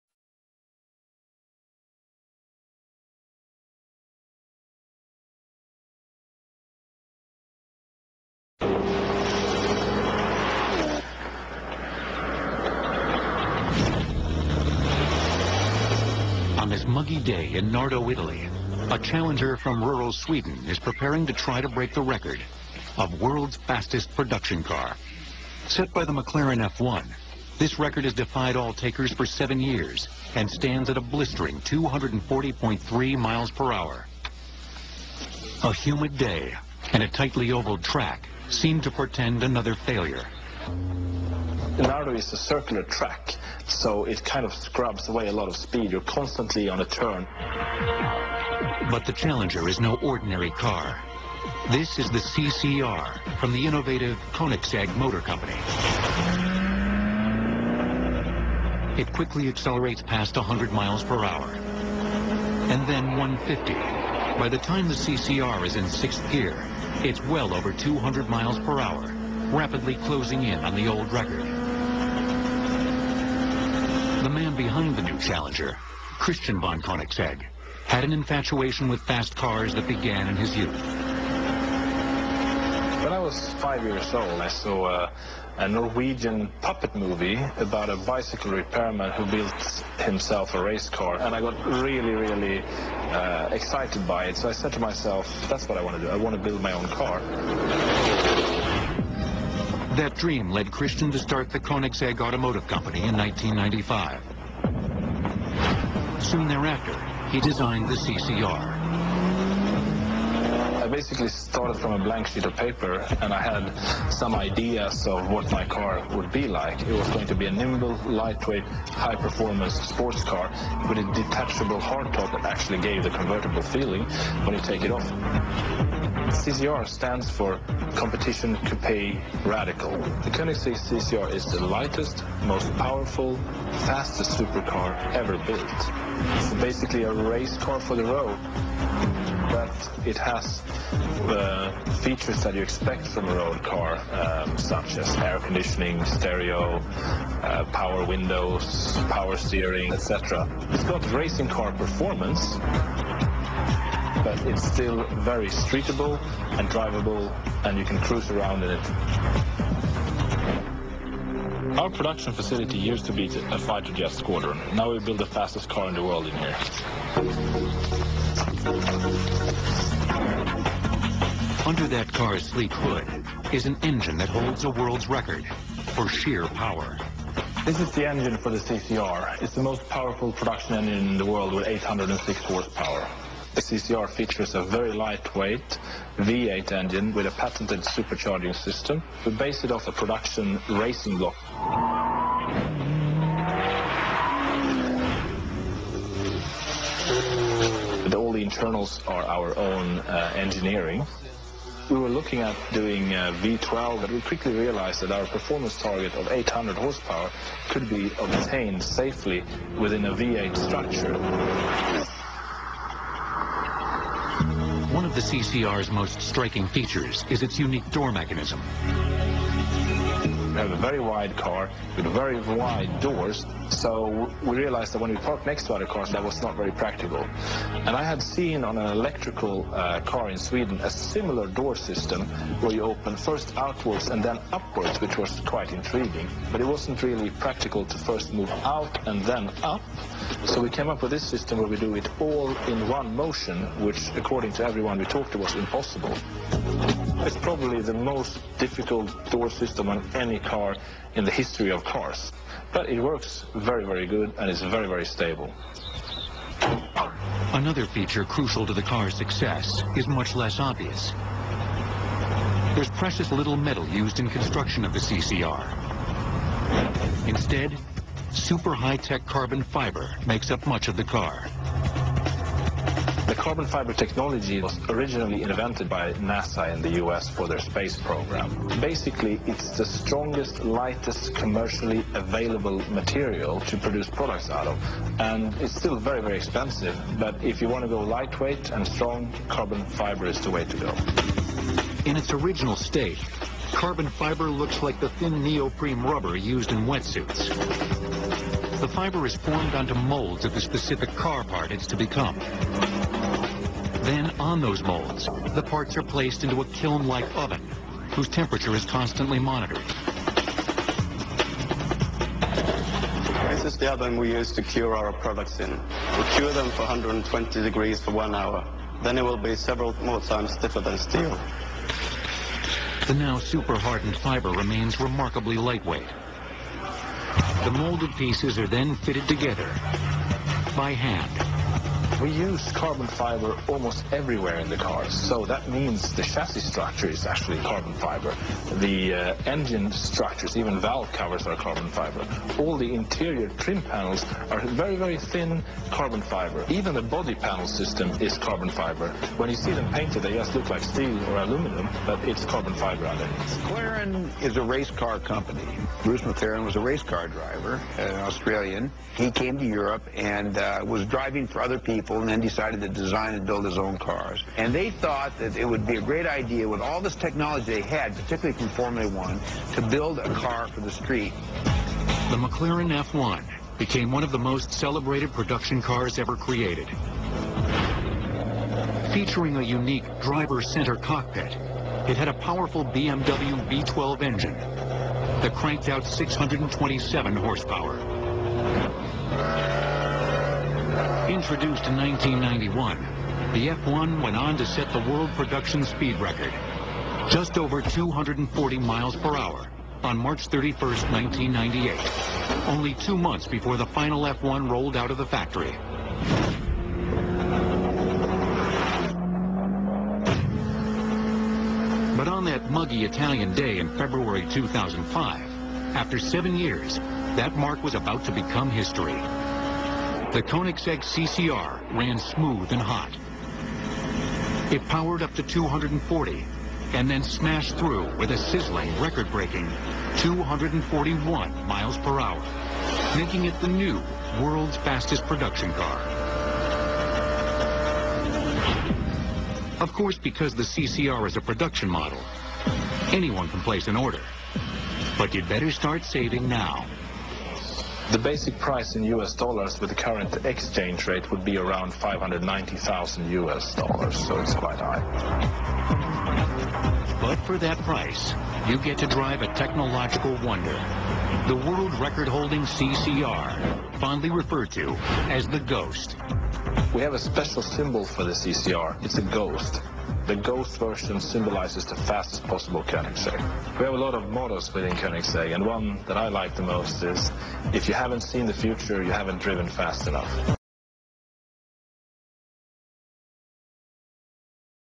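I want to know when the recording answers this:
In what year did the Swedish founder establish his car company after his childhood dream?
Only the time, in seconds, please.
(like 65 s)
103 s.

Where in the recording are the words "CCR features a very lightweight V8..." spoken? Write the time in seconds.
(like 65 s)
183 s.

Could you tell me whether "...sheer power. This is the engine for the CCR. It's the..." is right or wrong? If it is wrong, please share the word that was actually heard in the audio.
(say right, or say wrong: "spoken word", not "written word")
right.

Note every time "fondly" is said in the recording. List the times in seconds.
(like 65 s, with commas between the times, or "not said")
464 s.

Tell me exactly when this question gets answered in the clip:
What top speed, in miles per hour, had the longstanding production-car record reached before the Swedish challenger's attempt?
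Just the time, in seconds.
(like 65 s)
31 s.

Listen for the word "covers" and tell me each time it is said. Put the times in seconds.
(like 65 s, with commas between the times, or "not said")
341 s.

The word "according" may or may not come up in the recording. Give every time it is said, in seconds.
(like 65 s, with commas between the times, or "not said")
244 s.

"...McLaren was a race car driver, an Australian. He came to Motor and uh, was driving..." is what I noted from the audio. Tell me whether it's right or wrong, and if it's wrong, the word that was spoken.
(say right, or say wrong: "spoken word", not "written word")
wrong: "Europe", not "Motor".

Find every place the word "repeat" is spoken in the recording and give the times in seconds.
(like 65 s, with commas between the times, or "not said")
not said.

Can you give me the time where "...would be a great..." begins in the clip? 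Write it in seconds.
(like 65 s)
365 s.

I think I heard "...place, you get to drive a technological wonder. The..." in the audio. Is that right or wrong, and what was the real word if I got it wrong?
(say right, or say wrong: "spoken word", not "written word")
wrong: "price", not "place".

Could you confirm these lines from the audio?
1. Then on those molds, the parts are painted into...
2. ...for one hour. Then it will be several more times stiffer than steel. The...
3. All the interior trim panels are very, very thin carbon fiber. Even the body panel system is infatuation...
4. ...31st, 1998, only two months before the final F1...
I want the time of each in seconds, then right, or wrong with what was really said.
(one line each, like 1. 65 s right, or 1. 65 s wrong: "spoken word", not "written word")
1. 304 s wrong: "placed", not "painted"
2. 318 s right
3. 342 s wrong: "carbon", not "infatuation"
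4. 400 s right.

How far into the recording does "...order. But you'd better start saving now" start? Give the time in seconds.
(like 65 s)
443 s.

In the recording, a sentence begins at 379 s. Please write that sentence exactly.
Featuring a unique driver-center cockpit, it had a powerful BMW V12 engine that cranked out 627 horsepower.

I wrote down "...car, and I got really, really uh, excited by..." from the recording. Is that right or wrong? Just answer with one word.
right.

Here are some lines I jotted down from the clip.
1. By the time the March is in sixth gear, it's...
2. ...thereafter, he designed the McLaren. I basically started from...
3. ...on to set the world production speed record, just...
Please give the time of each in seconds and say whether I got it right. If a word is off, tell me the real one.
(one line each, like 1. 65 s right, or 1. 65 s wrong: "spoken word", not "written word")
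1. 64 s wrong: "CCR", not "March"
2. 106 s wrong: "CCR", not "McLaren"
3. 394 s right.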